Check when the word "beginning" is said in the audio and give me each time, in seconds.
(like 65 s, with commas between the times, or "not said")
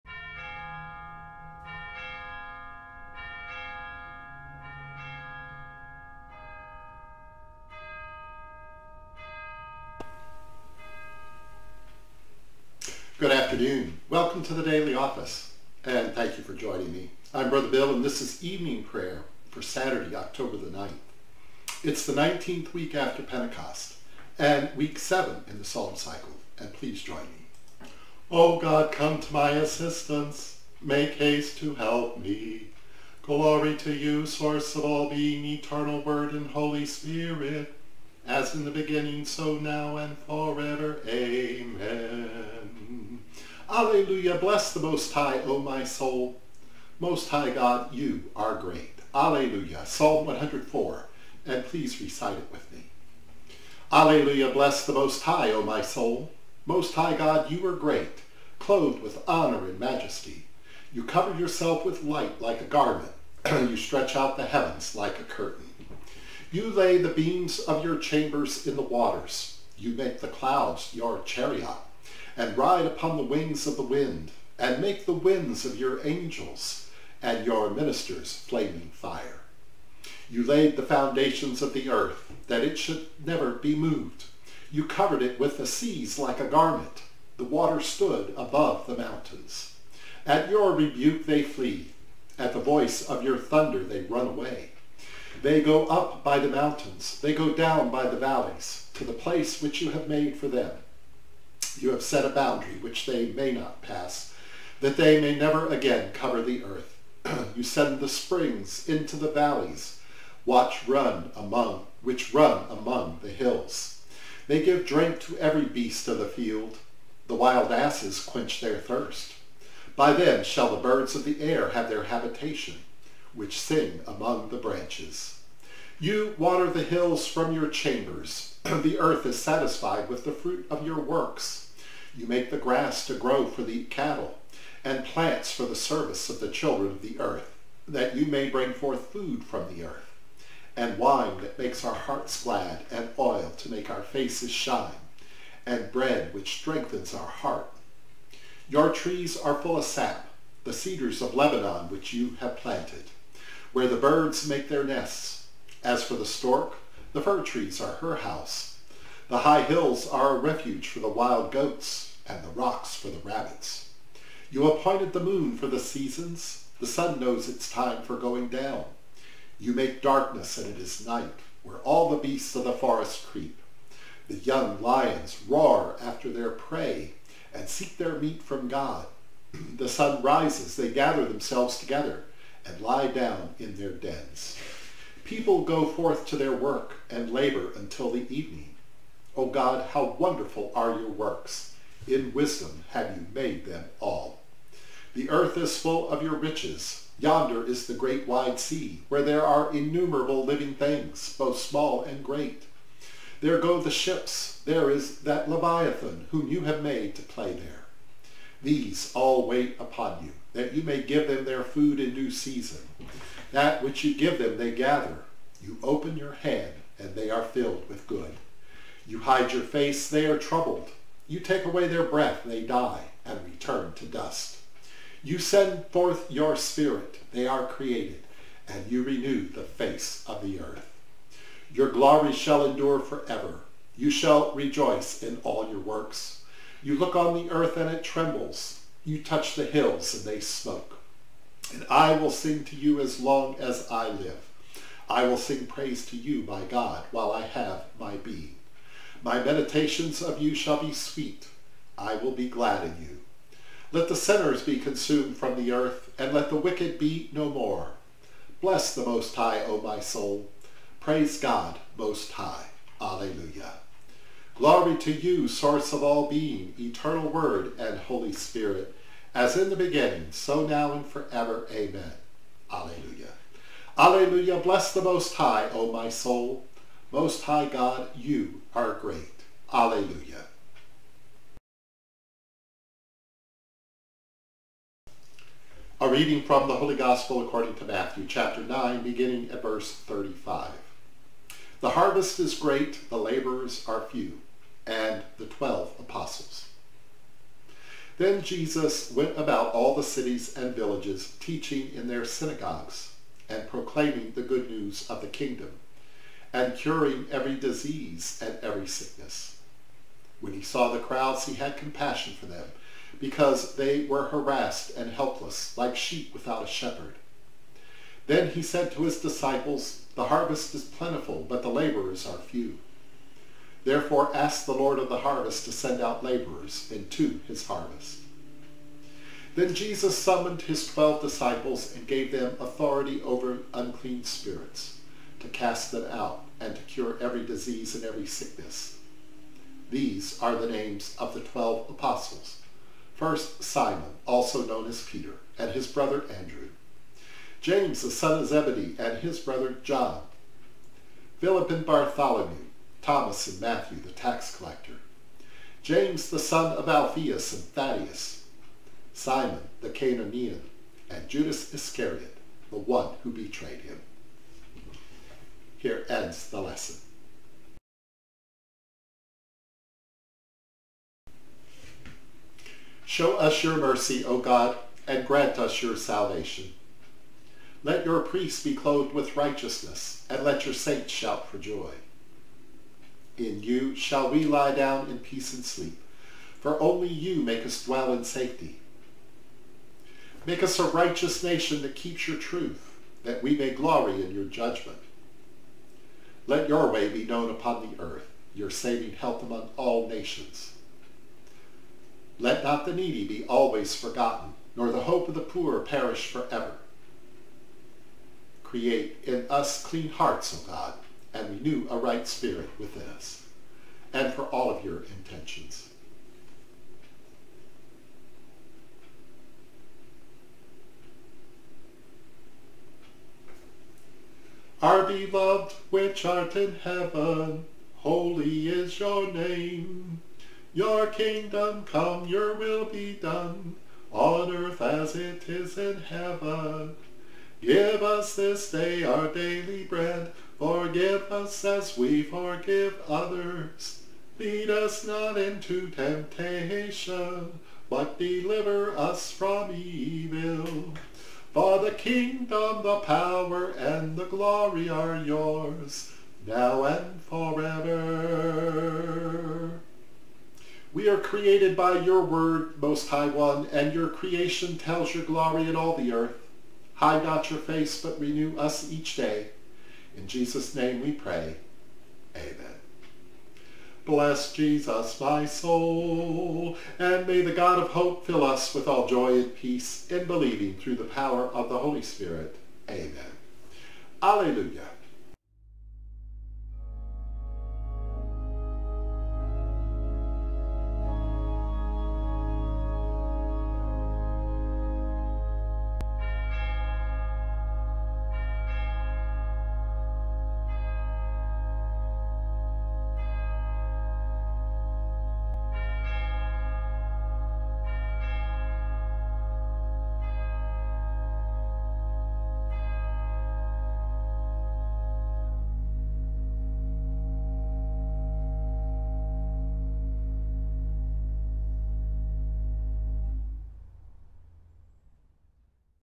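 38 s, 269 s, 289 s.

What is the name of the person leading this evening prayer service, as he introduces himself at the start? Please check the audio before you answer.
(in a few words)
Brother Bill.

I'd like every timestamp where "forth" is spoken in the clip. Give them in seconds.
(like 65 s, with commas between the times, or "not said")
138 s, 185 s, 225 s.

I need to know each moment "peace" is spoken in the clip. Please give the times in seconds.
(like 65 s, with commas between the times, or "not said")
385 s, 479 s.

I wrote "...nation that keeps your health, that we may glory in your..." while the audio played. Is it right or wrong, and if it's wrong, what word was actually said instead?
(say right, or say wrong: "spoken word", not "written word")
wrong: "truth", not "health".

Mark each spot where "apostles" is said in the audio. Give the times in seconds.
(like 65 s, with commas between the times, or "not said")
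295 s, 341 s.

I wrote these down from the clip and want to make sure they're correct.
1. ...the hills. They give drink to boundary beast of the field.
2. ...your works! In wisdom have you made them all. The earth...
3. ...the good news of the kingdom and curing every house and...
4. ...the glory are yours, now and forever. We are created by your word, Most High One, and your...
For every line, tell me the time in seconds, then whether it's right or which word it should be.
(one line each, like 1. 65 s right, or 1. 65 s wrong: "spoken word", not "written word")
1. 113 s wrong: "every", not "boundary"
2. 190 s right
3. 304 s wrong: "disease", not "house"
4. 454 s right.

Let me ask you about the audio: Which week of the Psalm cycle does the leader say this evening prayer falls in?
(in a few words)
7.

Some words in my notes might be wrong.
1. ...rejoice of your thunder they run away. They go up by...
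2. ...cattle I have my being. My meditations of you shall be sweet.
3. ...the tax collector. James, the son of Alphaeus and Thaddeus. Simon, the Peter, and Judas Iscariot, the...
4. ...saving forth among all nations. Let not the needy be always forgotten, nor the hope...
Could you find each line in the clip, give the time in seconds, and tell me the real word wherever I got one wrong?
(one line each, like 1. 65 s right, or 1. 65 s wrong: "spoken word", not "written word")
1. 92 s wrong: "voice", not "rejoice"
2. 247 s wrong: "while", not "cattle"
3. 353 s wrong: "Cananaean", not "Peter"
4. 398 s wrong: "health", not "forth".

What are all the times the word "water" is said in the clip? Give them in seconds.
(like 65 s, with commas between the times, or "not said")
68 s, 87 s, 126 s.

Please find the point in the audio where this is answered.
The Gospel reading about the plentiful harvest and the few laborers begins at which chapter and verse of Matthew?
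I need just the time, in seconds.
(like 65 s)
288 s.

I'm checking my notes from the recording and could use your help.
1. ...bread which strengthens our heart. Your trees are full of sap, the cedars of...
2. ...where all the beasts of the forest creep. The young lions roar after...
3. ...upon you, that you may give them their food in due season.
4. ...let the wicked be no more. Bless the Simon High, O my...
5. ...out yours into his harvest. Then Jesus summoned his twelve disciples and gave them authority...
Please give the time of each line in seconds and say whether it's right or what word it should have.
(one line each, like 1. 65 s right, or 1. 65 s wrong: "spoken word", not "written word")
1. 145 s right
2. 171 s right
3. 209 s right
4. 256 s wrong: "Most", not "Simon"
5. 326 s wrong: "laborers", not "yours".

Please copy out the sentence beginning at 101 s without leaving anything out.
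You have set a boundary which they may not pass, that they may never again cover the earth.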